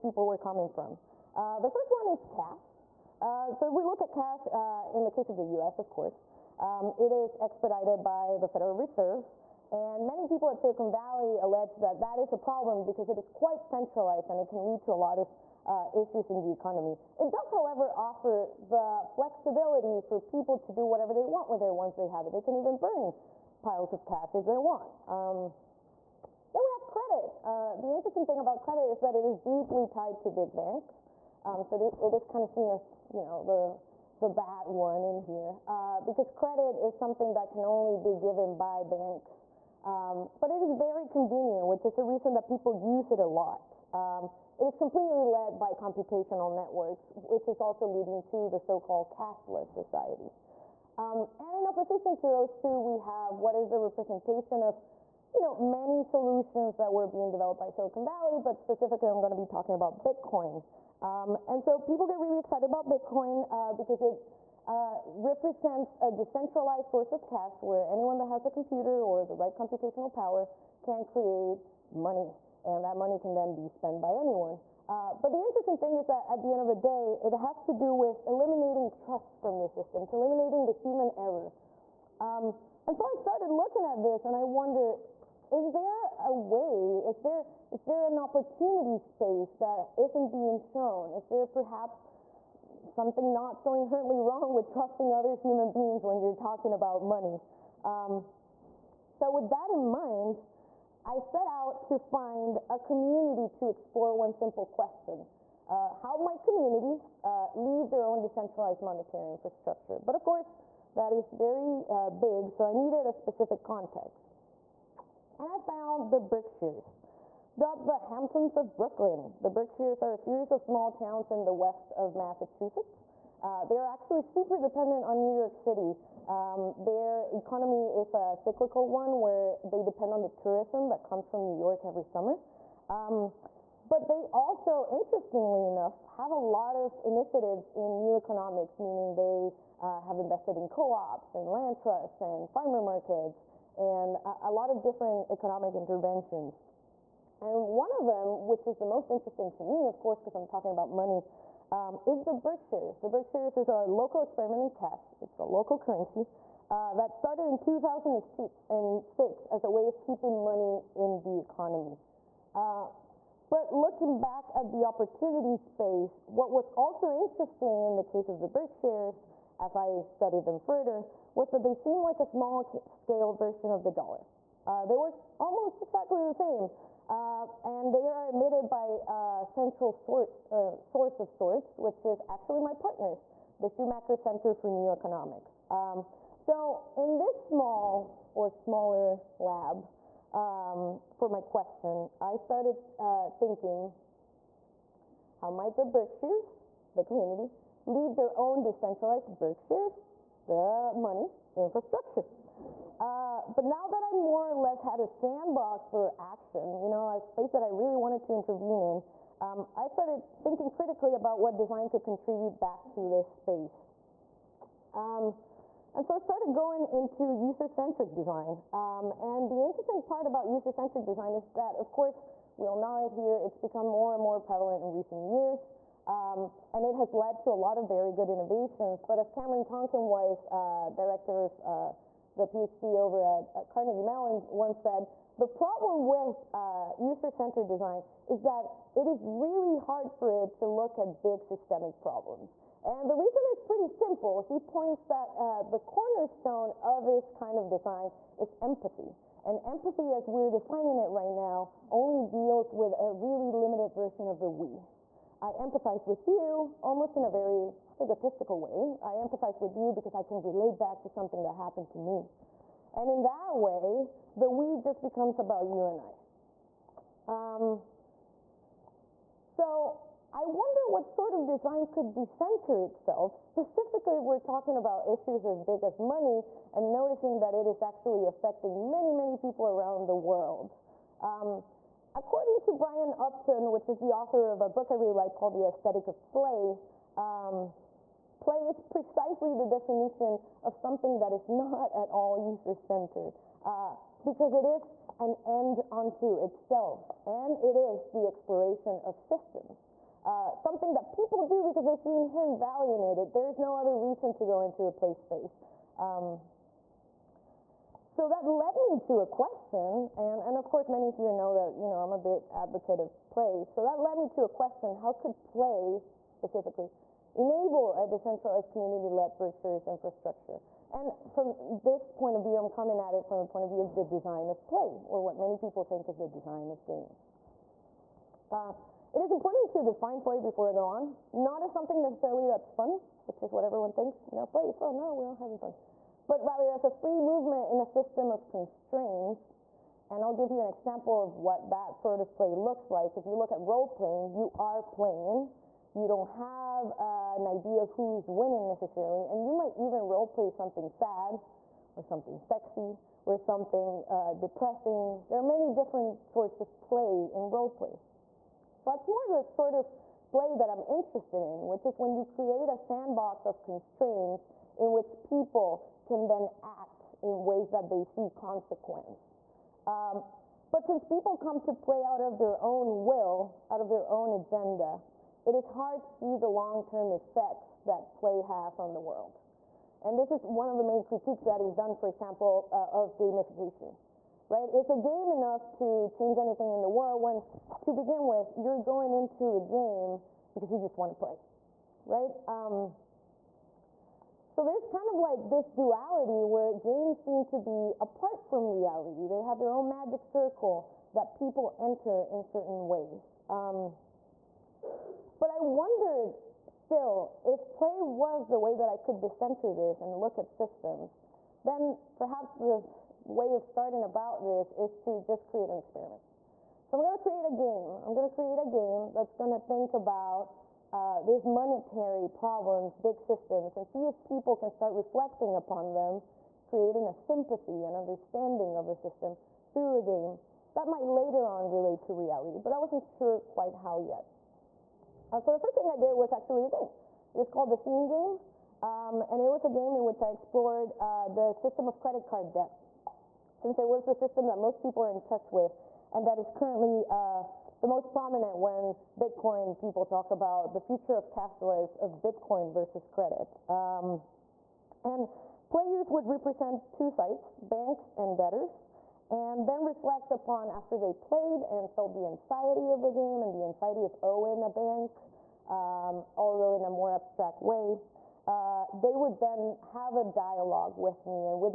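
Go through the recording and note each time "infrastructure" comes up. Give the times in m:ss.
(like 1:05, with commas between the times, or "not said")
1:49, 3:21, 5:19.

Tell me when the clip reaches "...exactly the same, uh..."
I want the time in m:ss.
2:55.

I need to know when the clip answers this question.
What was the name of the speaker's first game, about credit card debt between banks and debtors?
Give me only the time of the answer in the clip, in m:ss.
7:17.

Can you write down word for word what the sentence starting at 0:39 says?
Um, but it is very convenient, which is the reason that people use it a lot.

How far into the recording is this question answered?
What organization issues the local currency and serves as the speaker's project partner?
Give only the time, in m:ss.
3:03.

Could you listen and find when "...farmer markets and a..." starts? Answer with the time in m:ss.
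2:22.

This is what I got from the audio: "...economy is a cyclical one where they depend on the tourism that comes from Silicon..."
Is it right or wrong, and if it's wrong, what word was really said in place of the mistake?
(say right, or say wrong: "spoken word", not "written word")
wrong: "New", not "Silicon".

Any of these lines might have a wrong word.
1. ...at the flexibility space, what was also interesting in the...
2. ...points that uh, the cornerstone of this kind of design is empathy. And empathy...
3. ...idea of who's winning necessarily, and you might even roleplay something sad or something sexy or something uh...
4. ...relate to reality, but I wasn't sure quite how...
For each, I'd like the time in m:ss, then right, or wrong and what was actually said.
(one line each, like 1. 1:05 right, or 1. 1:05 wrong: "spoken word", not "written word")
1. 2:44 wrong: "opportunity", not "flexibility"
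2. 4:04 right
3. 5:47 right
4. 7:11 right.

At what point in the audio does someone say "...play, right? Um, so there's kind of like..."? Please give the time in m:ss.
6:31.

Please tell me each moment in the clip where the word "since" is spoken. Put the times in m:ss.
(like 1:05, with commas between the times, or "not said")
6:10, 7:23.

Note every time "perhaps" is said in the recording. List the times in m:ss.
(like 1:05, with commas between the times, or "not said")
1:31, 6:52.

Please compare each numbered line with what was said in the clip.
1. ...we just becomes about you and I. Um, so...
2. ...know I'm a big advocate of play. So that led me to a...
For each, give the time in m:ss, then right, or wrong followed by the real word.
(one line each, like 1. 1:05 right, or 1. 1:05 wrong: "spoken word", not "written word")
1. 4:24 right
2. 5:11 right.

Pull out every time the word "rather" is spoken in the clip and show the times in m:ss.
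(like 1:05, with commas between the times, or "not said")
5:36.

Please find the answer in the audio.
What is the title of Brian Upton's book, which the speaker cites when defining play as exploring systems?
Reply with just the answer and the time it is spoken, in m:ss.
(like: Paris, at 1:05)
The Aesthetic of Play, at 4:45.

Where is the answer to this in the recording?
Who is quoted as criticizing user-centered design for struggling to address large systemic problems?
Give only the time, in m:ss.
3:49.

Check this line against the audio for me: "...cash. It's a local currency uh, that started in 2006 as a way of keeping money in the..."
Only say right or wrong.
right.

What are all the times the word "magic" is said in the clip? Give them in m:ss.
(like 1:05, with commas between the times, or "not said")
6:39.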